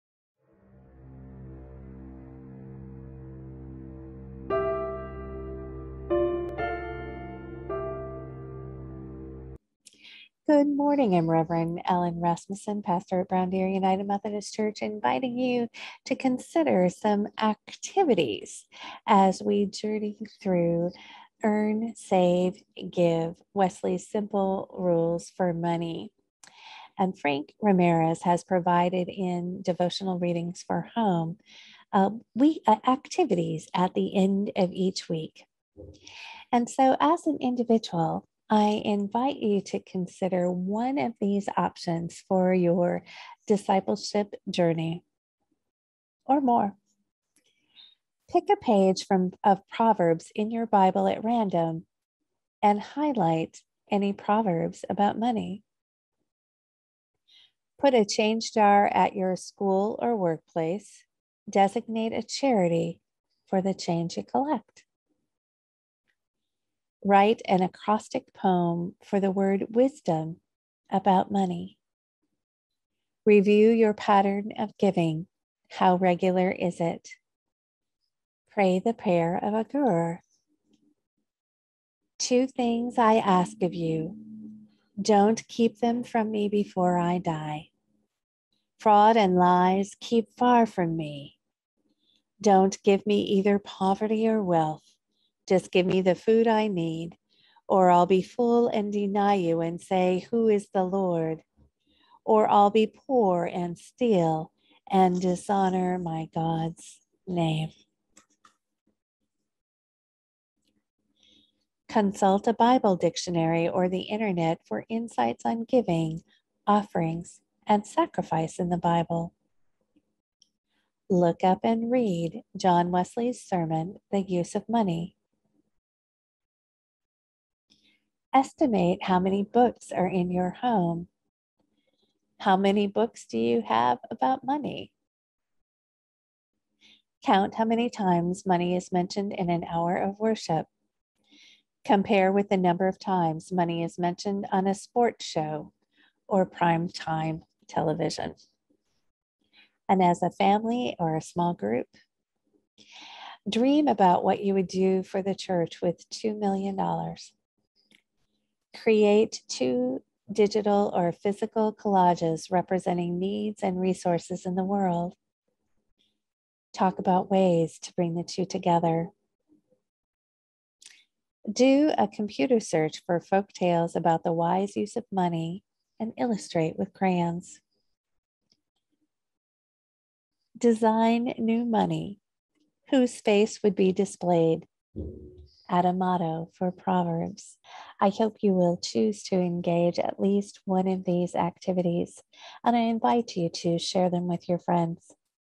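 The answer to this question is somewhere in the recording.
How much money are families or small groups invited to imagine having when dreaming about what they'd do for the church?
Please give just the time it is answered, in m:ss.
2:36.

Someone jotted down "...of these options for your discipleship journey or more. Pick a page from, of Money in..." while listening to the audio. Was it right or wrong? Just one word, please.
wrong.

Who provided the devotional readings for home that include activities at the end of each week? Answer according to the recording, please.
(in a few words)
Frank Ramirez.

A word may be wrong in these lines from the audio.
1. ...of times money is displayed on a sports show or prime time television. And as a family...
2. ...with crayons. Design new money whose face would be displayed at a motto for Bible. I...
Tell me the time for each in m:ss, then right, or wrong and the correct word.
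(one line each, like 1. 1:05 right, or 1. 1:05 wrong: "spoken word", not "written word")
1. 2:22 wrong: "mentioned", not "displayed"
2. 2:56 wrong: "Proverbs", not "Bible".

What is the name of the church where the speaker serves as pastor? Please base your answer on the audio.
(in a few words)
Brown Deer United Methodist Church.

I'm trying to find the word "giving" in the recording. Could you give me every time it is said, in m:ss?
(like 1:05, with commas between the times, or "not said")
1:14, 1:55.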